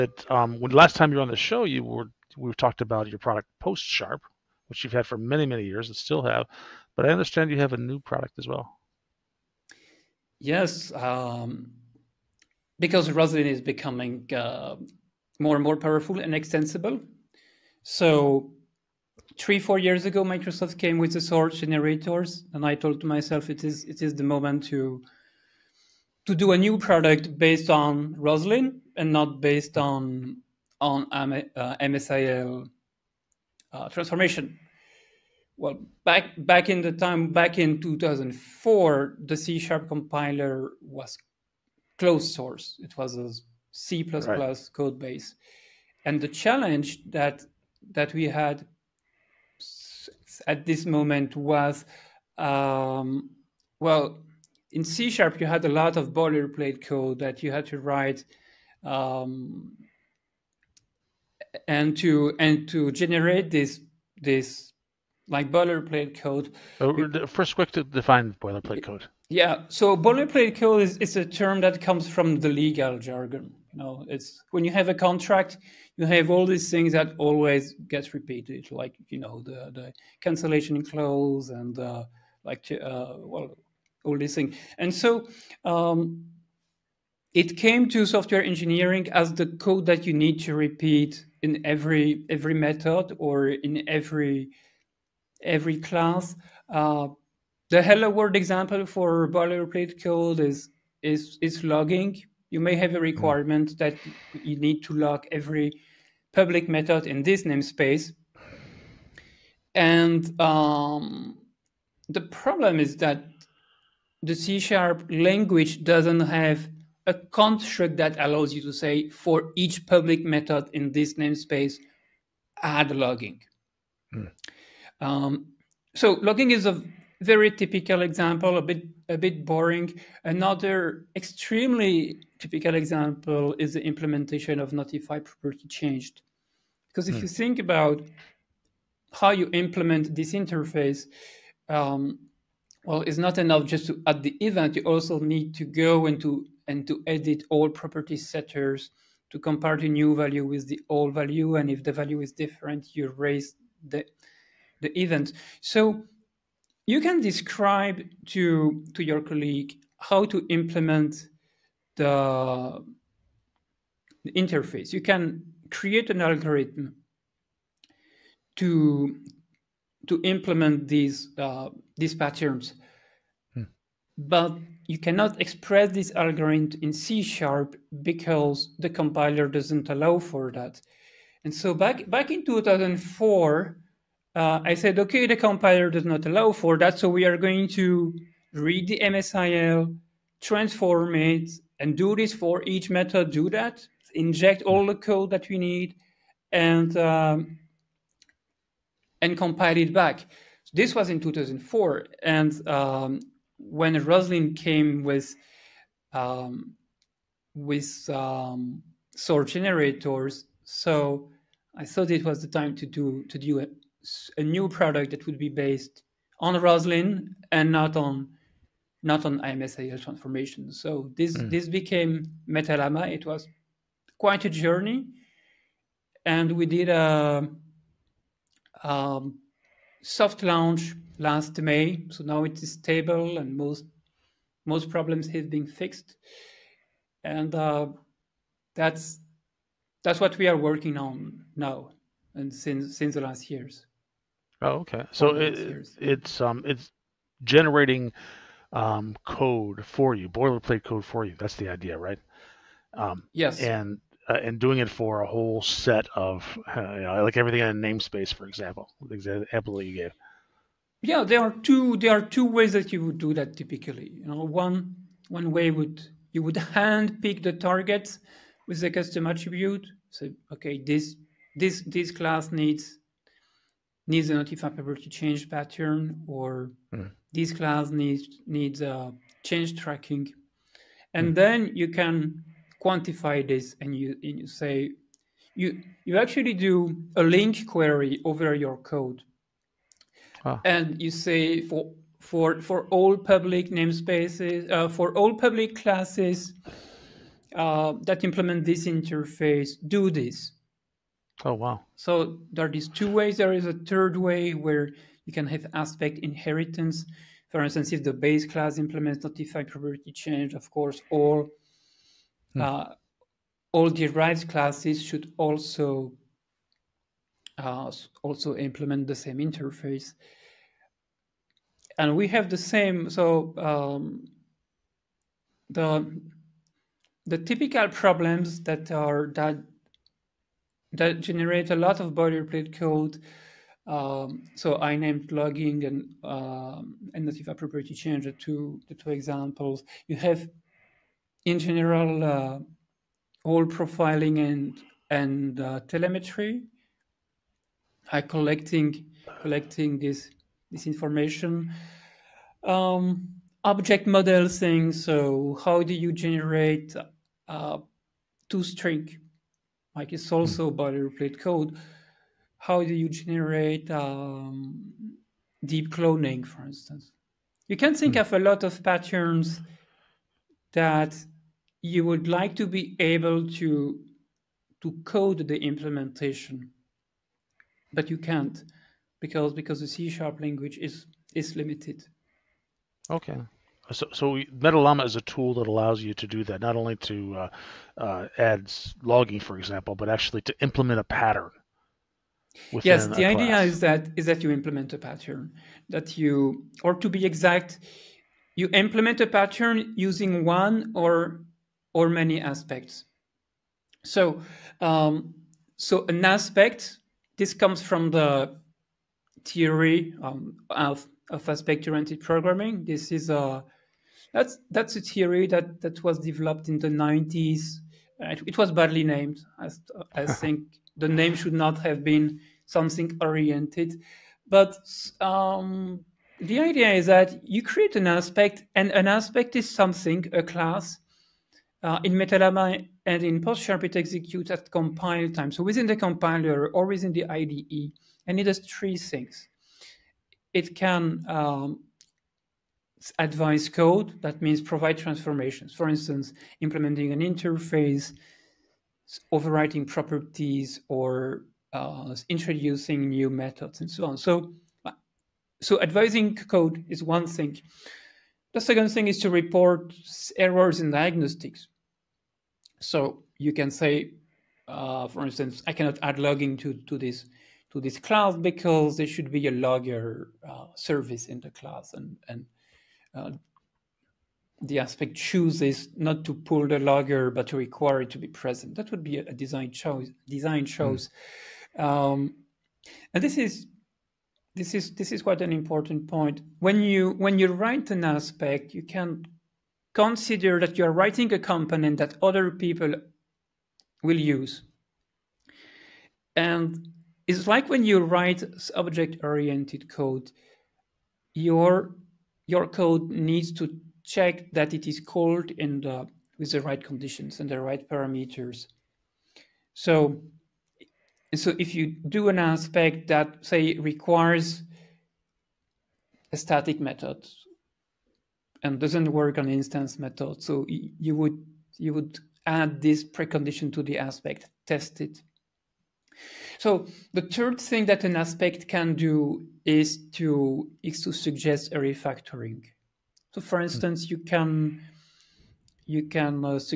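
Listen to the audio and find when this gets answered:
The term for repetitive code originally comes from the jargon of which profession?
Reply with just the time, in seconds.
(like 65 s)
72 s.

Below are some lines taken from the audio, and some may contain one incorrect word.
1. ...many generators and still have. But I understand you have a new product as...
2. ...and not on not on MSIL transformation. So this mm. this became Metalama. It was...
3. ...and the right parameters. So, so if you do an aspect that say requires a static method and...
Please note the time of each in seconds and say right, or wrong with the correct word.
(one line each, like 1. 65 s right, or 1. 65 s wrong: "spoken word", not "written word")
1. 5 s wrong: "years", not "generators"
2. 217 s right
3. 507 s right.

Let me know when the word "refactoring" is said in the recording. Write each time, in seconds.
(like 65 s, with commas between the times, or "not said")
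531 s.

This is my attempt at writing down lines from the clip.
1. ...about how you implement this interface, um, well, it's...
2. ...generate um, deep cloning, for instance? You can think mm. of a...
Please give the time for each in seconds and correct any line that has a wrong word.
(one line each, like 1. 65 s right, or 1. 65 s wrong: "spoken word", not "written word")
1. 137 s right
2. 363 s right.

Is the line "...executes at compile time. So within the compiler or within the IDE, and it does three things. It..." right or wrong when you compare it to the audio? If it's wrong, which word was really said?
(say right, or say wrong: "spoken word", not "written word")
right.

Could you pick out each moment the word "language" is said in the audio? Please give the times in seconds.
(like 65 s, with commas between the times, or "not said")
115 s, 380 s.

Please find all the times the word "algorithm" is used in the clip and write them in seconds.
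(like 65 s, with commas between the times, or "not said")
166 s, 176 s.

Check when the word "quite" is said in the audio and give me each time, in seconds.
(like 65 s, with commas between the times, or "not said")
224 s, 485 s.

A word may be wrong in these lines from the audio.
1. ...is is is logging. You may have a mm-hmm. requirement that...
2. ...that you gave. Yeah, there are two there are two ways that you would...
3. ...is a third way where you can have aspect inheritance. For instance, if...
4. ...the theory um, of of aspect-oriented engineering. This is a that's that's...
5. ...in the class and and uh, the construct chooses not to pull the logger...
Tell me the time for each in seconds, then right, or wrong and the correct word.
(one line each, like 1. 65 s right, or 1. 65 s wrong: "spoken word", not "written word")
1. 100 s right
2. 259 s right
3. 303 s right
4. 408 s wrong: "programming", not "engineering"
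5. 471 s wrong: "aspect", not "construct".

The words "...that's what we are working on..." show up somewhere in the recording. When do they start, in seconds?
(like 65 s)
240 s.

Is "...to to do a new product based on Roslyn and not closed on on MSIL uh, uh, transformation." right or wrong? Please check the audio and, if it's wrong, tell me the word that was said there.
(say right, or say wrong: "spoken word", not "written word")
wrong: "based", not "closed".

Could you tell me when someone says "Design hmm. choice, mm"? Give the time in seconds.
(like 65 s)
480 s.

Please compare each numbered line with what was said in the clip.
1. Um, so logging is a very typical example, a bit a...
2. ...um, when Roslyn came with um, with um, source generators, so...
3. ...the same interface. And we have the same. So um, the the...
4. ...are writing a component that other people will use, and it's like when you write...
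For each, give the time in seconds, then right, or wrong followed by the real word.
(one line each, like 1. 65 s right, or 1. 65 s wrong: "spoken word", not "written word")
1. 125 s right
2. 202 s right
3. 319 s right
4. 490 s right.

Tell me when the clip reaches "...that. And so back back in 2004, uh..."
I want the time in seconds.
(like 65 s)
180 s.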